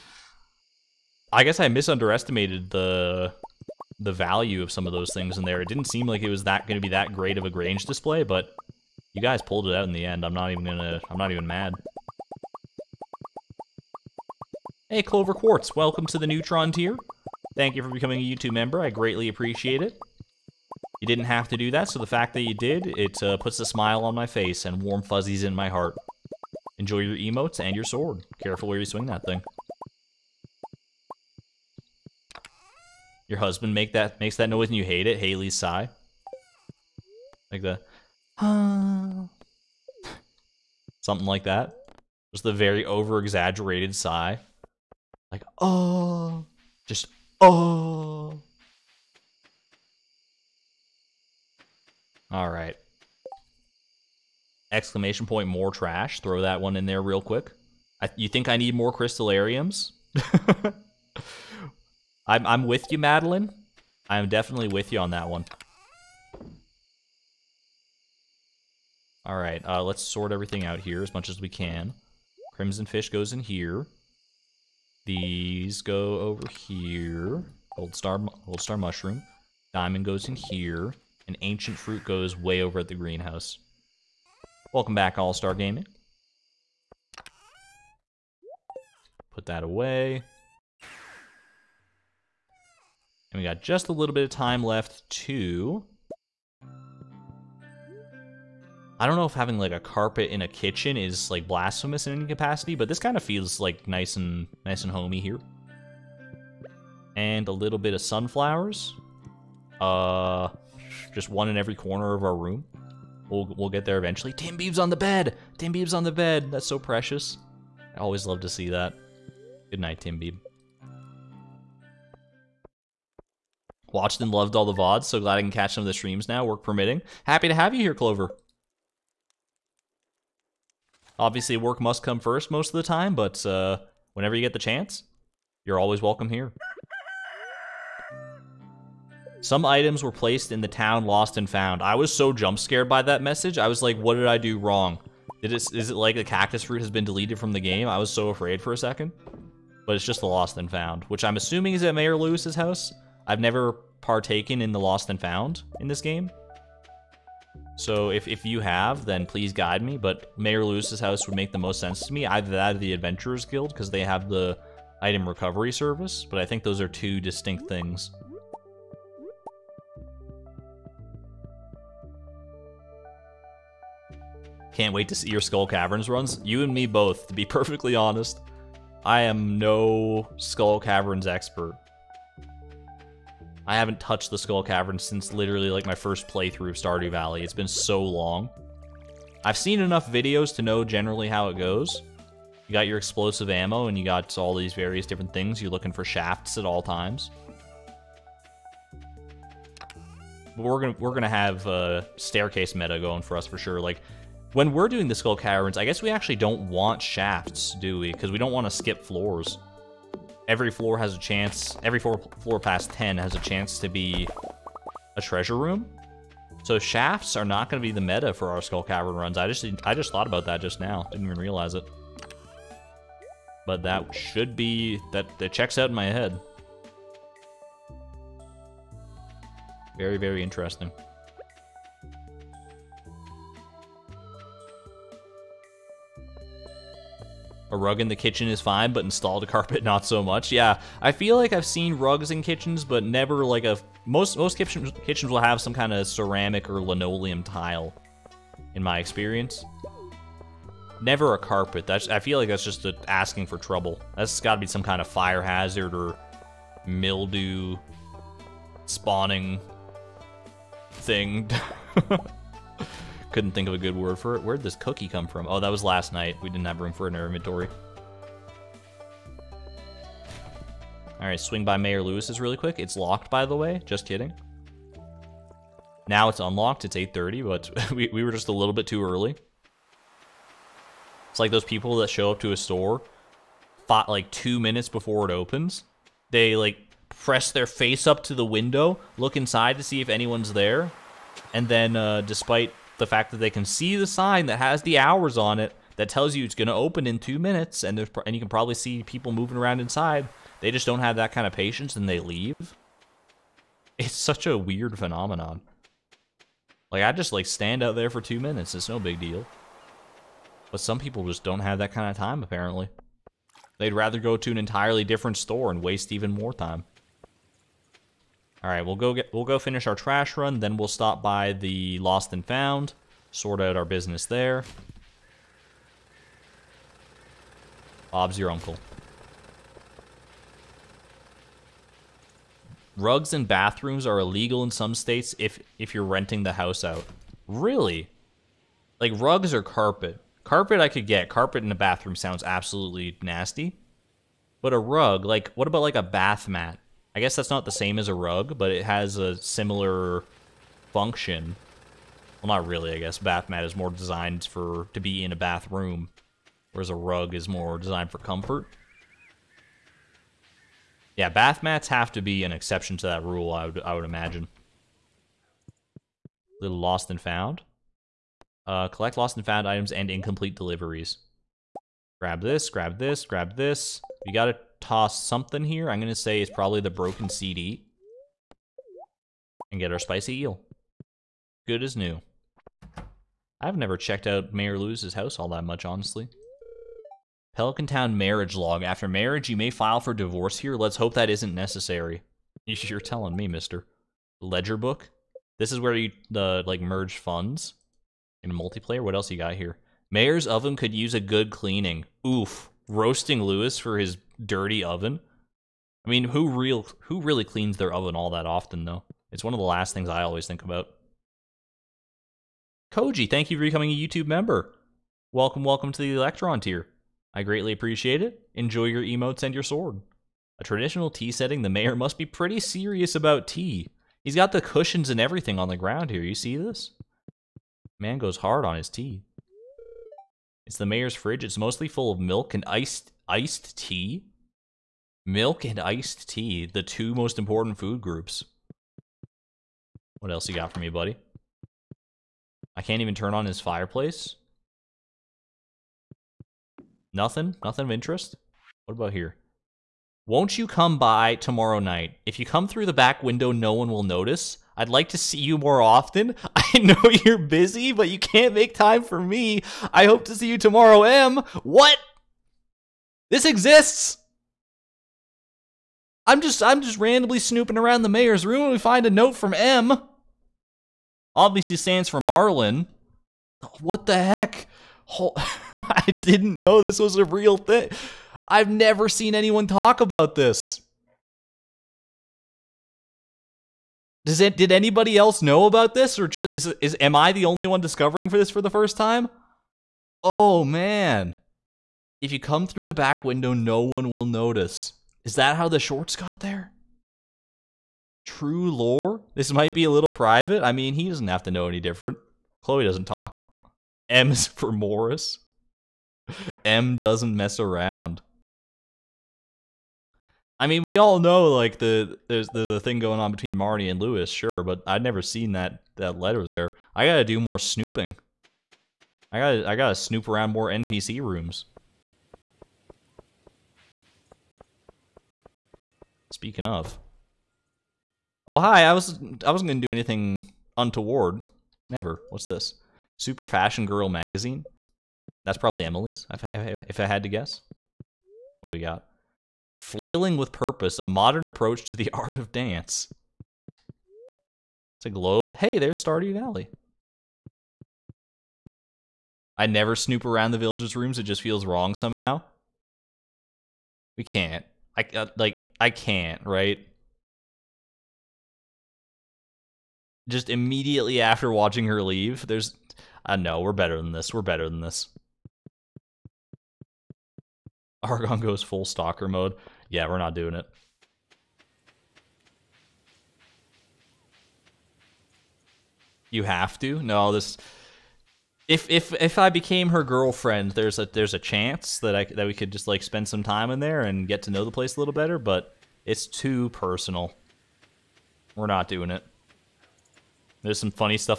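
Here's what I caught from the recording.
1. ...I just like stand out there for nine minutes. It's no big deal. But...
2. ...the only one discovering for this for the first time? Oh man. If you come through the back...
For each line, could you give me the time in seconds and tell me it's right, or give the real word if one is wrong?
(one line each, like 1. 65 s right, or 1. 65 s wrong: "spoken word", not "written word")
1. 307 s wrong: "two", not "nine"
2. 487 s right.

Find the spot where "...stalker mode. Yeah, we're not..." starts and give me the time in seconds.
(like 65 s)
568 s.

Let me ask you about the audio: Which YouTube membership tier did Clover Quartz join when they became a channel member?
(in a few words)
Neutron tier.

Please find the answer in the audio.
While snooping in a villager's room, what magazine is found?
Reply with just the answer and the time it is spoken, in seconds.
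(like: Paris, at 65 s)
Super Fashion Girl, at 533 s.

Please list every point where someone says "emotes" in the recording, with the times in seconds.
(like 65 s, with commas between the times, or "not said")
27 s, 419 s.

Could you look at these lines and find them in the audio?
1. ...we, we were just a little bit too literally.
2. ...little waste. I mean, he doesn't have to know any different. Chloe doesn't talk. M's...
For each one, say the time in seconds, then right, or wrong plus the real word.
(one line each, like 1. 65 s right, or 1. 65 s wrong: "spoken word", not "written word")
1. 277 s wrong: "early", not "literally"
2. 499 s wrong: "private", not "waste".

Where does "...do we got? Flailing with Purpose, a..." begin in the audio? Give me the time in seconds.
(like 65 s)
538 s.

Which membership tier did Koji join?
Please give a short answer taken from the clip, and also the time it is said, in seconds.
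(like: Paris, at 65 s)
Electron tier, at 416 s.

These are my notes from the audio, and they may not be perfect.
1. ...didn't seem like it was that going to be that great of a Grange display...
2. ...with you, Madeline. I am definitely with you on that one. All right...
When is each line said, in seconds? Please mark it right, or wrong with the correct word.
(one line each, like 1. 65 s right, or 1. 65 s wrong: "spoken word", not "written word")
1. 5 s right
2. 62 s right.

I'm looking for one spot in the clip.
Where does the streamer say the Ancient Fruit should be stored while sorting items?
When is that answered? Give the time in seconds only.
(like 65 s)
82 s.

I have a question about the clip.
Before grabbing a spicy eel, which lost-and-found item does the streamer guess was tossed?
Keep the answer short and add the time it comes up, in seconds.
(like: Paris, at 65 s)
broken CD, at 376 s.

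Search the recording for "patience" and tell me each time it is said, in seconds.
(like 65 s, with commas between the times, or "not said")
301 s.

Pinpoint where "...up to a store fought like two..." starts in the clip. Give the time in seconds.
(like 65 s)
282 s.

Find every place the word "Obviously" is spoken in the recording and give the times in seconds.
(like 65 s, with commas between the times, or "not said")
131 s, 471 s.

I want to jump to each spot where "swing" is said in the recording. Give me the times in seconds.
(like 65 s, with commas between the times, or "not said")
28 s, 271 s.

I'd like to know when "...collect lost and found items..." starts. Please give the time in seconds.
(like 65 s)
368 s.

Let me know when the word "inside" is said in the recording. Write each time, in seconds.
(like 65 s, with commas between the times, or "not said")
289 s, 299 s.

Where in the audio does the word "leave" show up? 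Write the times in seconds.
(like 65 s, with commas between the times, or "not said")
302 s, 562 s.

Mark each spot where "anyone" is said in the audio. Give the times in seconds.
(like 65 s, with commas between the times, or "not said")
290 s, 479 s.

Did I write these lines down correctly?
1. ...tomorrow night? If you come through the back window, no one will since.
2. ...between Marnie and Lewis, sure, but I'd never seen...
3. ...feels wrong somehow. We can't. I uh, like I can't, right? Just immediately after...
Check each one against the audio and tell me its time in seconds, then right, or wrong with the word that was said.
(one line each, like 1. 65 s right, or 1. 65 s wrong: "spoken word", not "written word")
1. 451 s wrong: "notice", not "since"
2. 513 s right
3. 551 s right.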